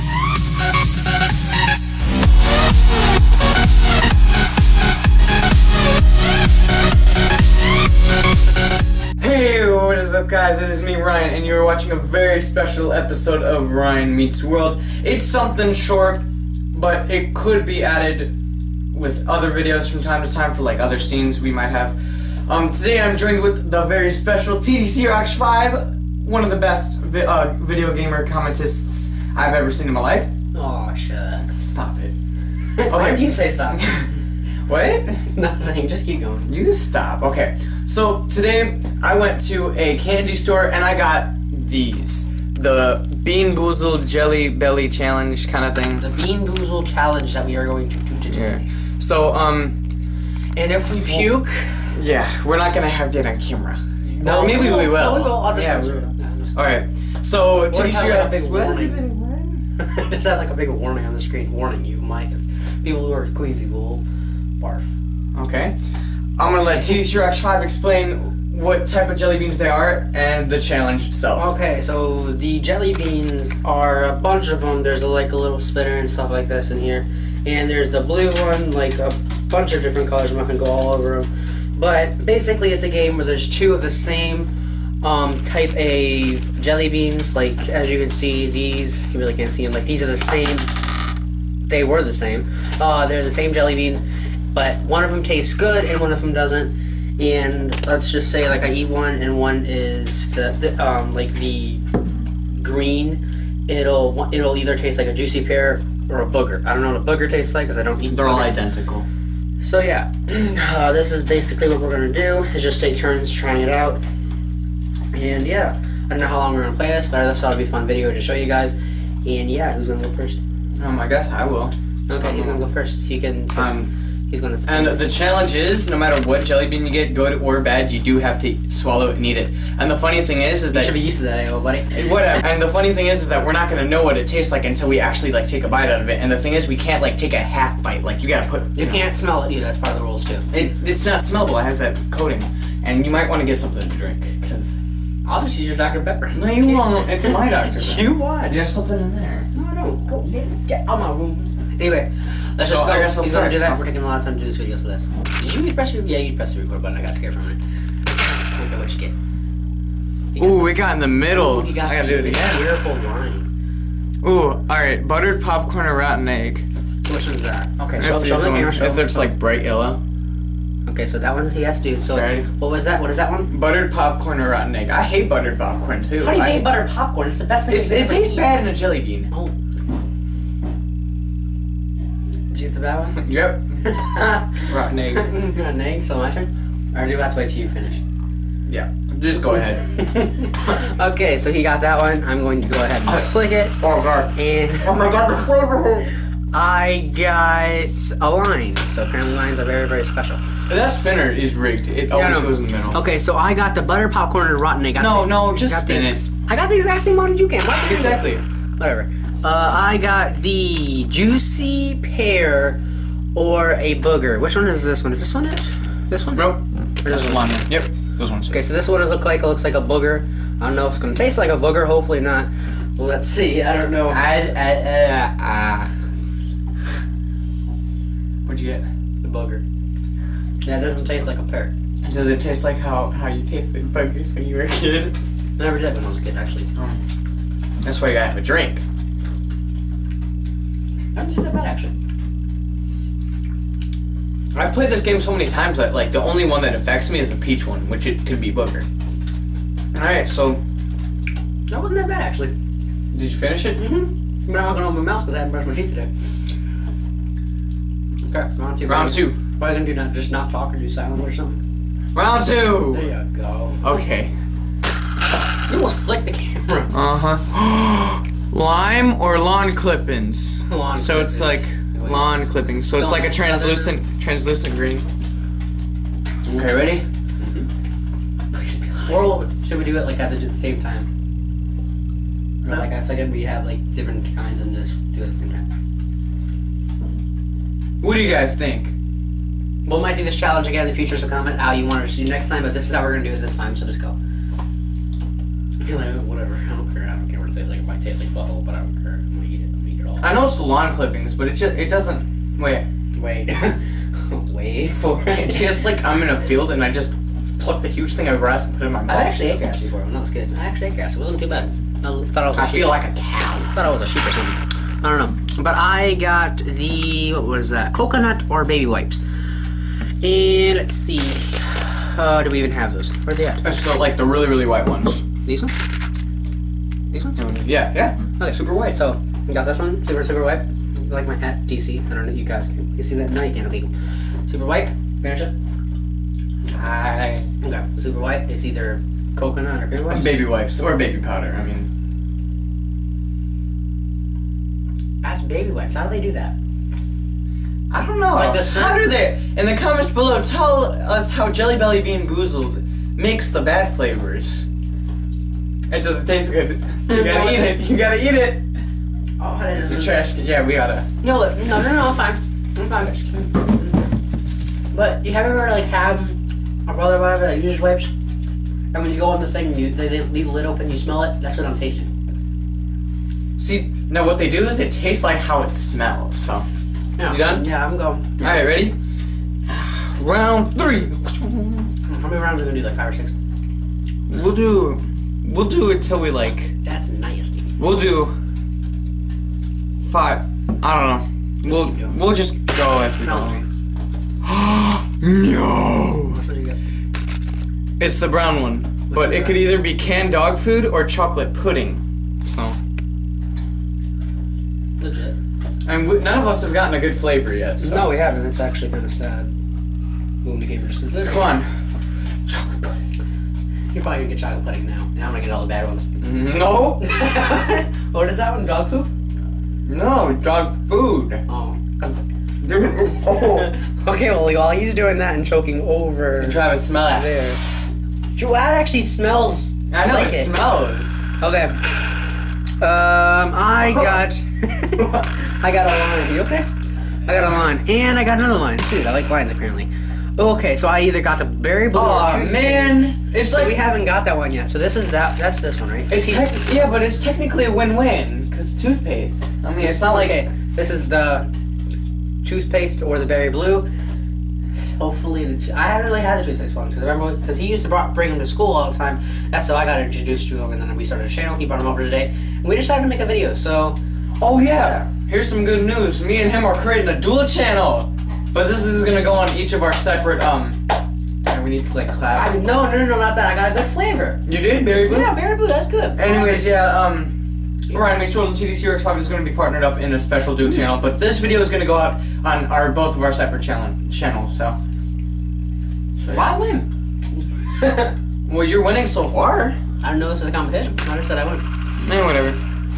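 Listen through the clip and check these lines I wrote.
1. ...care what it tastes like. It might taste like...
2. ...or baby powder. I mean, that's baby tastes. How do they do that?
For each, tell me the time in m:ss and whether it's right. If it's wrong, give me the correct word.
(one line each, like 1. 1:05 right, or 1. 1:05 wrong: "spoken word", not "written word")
1. 4:57 right
2. 5:40 wrong: "wipes", not "tastes".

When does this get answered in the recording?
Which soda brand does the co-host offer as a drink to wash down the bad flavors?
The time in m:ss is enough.
2:25.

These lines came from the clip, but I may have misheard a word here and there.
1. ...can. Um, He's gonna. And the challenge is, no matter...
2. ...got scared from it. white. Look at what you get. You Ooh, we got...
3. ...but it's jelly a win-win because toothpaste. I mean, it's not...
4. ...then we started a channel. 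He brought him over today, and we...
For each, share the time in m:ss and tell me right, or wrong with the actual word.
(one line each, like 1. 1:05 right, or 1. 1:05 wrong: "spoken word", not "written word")
1. 2:03 right
2. 2:37 wrong: "minute", not "white"
3. 7:26 wrong: "technically", not "jelly"
4. 7:40 right.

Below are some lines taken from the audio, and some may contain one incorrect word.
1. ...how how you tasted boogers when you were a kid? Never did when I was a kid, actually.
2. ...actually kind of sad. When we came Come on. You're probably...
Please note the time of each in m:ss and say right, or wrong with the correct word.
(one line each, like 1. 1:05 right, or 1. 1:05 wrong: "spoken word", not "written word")
1. 3:52 right
2. 6:48 right.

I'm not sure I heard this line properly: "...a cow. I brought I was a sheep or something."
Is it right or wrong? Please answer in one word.
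wrong.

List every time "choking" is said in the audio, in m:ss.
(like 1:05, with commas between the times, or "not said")
7:05.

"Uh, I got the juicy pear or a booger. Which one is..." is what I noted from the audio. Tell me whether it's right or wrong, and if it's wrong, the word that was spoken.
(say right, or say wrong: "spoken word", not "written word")
right.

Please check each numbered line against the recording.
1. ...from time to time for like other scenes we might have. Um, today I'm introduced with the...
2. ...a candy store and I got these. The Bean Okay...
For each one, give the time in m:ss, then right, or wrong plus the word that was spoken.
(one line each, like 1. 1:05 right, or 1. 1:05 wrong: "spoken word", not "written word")
1. 0:19 wrong: "joined", not "introduced"
2. 0:39 wrong: "Boozled", not "Okay".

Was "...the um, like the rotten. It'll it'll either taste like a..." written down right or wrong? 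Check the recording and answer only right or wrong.
wrong.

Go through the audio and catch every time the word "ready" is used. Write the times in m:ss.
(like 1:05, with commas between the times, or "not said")
4:36, 6:18.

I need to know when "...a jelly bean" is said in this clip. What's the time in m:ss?
2:58.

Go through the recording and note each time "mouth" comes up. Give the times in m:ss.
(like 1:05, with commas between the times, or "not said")
4:15, 5:09.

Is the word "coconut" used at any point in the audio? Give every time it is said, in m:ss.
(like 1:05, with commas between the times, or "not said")
5:17, 5:39.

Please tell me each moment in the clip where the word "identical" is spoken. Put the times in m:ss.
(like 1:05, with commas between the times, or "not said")
1:48.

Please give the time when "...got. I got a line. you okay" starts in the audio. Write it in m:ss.
7:13.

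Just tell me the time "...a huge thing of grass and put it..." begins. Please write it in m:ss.
5:07.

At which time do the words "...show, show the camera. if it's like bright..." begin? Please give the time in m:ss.
2:48.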